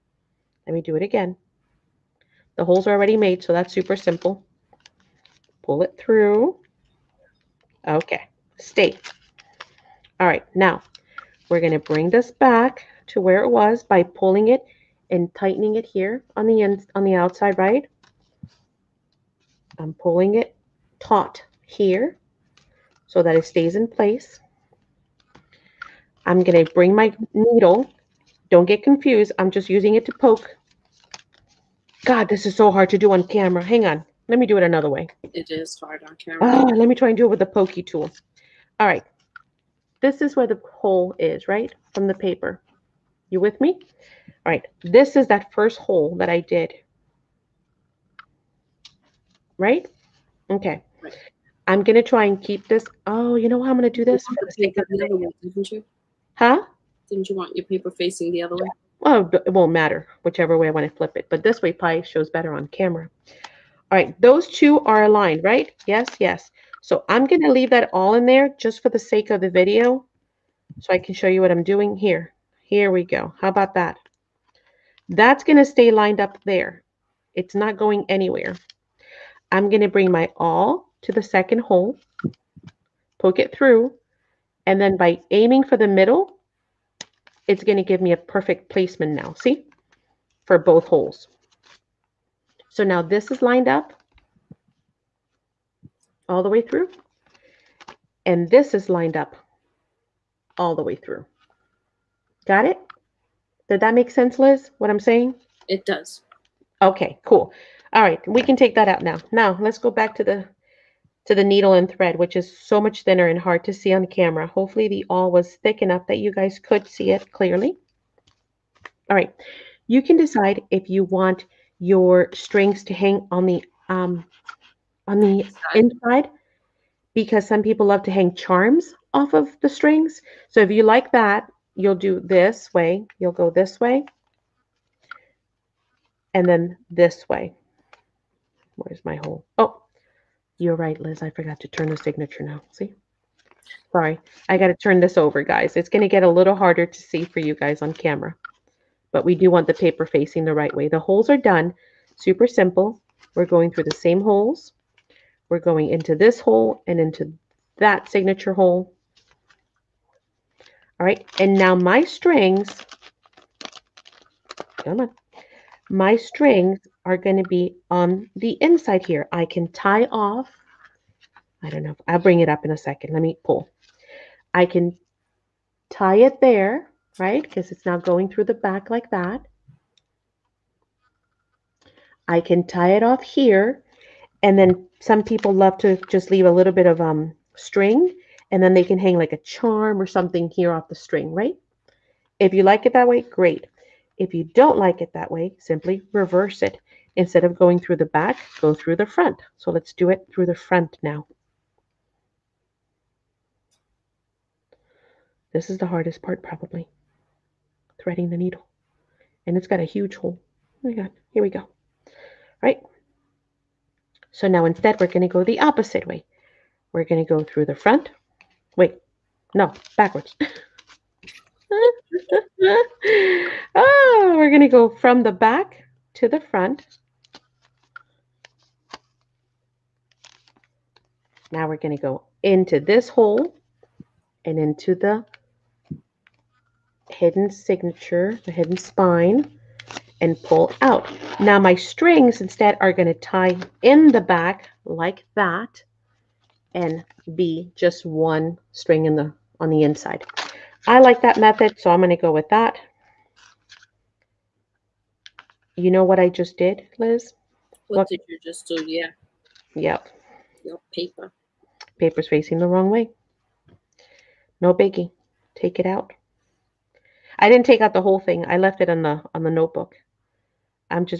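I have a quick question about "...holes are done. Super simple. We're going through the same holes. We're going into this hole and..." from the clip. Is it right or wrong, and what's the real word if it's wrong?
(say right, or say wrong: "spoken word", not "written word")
right.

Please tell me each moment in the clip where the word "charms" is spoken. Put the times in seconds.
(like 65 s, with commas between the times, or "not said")
128 s, 189 s.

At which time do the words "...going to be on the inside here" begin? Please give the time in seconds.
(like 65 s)
167 s.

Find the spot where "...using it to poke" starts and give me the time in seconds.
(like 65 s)
29 s.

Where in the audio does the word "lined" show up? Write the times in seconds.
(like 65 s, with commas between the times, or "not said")
75 s, 93 s, 98 s.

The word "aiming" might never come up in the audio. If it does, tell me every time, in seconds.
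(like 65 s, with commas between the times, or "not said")
85 s.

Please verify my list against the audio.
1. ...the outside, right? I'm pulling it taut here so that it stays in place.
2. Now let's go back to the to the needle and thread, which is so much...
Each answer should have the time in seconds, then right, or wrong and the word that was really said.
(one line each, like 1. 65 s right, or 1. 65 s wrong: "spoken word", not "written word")
1. 17 s right
2. 109 s right.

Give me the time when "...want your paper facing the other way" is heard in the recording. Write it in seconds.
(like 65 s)
57 s.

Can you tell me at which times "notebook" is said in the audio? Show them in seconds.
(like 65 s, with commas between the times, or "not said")
269 s.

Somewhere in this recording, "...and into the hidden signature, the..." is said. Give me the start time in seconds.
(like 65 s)
234 s.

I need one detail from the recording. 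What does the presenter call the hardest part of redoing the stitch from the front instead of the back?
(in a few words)
threading the needle.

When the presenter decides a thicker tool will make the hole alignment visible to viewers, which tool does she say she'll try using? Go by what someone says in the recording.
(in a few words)
pokey tool.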